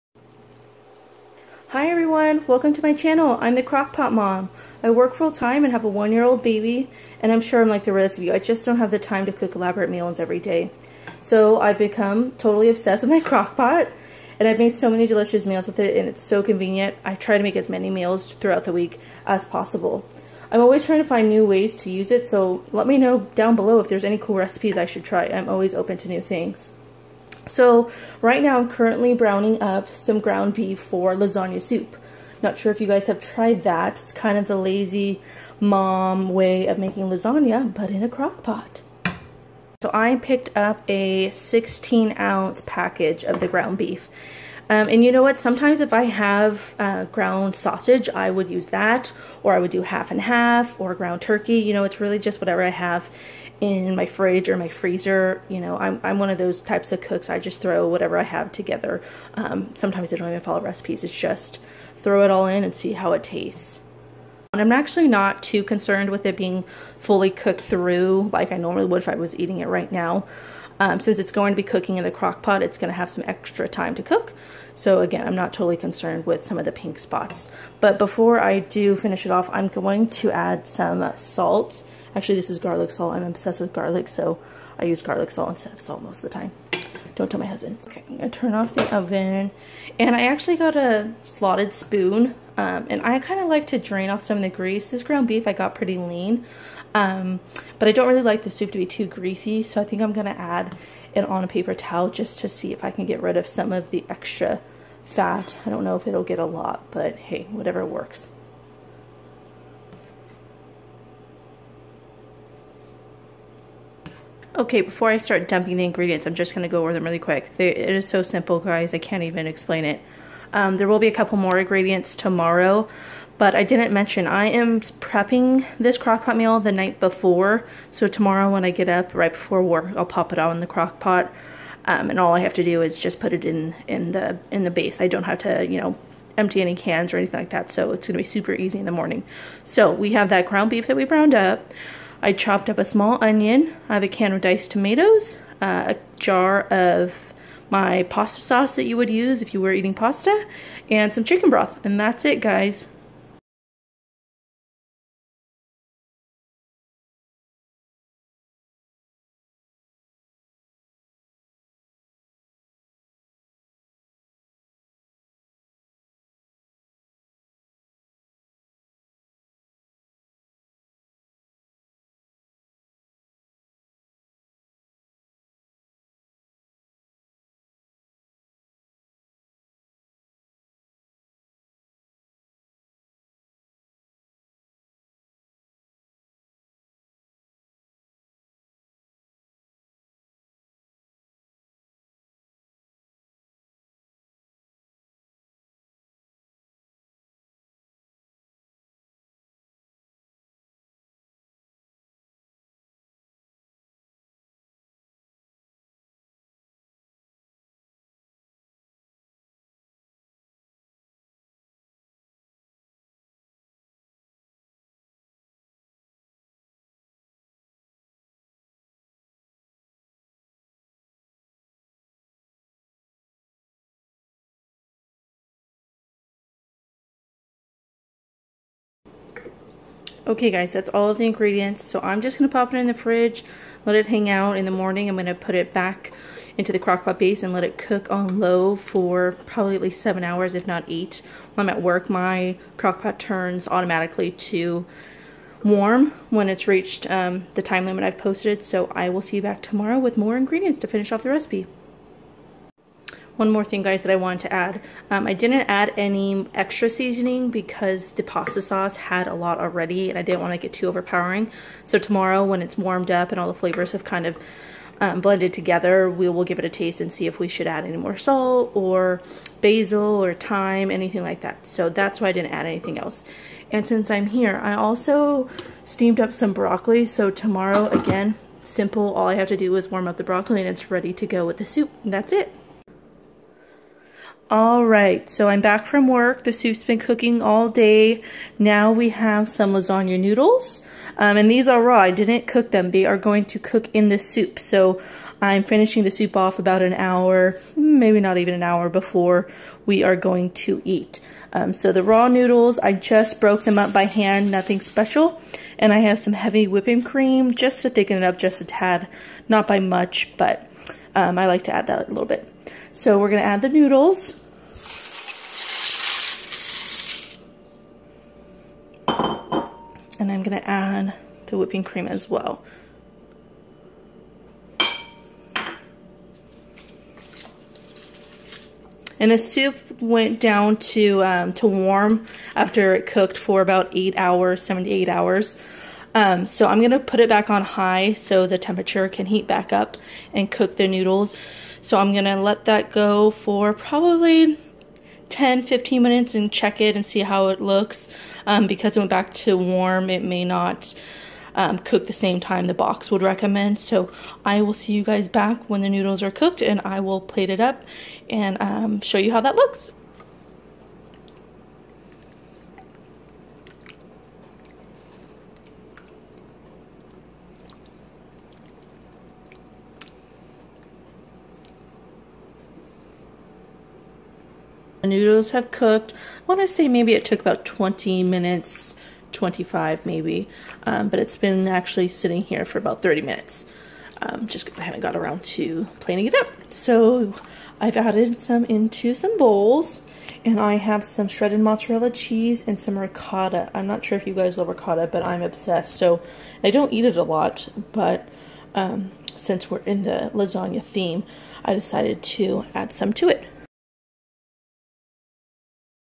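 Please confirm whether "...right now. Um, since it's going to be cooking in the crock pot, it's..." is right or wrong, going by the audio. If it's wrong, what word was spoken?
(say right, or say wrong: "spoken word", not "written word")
right.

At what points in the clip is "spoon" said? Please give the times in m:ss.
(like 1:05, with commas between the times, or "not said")
1:31.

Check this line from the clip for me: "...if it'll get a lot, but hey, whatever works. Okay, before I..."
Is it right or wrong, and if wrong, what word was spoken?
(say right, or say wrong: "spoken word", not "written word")
right.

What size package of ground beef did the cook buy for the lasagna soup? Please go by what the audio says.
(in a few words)
16 ounce.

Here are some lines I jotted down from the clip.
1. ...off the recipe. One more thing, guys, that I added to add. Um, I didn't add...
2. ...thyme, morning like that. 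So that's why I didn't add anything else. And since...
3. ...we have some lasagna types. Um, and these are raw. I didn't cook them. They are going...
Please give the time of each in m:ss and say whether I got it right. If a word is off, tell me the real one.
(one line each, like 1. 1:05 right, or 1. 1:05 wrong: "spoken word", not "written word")
1. 4:11 wrong: "wanted", not "added"
2. 4:30 wrong: "anything", not "morning"
3. 4:48 wrong: "noodles", not "types".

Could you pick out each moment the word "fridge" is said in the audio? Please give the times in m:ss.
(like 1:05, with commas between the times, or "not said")
0:54, 3:52.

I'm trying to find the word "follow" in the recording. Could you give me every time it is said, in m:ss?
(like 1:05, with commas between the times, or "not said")
1:00.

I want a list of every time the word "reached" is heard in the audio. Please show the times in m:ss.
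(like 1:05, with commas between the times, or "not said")
4:06.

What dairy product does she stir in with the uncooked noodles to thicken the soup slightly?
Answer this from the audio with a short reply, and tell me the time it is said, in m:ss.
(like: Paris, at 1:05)
heavy whipping cream, at 5:06.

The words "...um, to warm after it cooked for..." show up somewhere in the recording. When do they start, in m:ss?
5:31.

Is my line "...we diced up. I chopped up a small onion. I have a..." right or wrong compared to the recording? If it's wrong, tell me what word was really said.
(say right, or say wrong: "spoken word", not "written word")
wrong: "browned", not "diced".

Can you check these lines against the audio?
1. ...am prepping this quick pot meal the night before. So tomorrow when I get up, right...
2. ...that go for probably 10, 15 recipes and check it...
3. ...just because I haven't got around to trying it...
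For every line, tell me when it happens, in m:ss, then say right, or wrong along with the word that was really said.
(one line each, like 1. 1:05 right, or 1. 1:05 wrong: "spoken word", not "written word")
1. 2:04 wrong: "crock", not "quick"
2. 5:42 wrong: "minutes", not "recipes"
3. 6:24 wrong: "planning", not "trying".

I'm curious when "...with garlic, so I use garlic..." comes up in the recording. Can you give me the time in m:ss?
1:23.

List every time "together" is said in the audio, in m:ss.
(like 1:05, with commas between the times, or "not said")
0:58, 4:25.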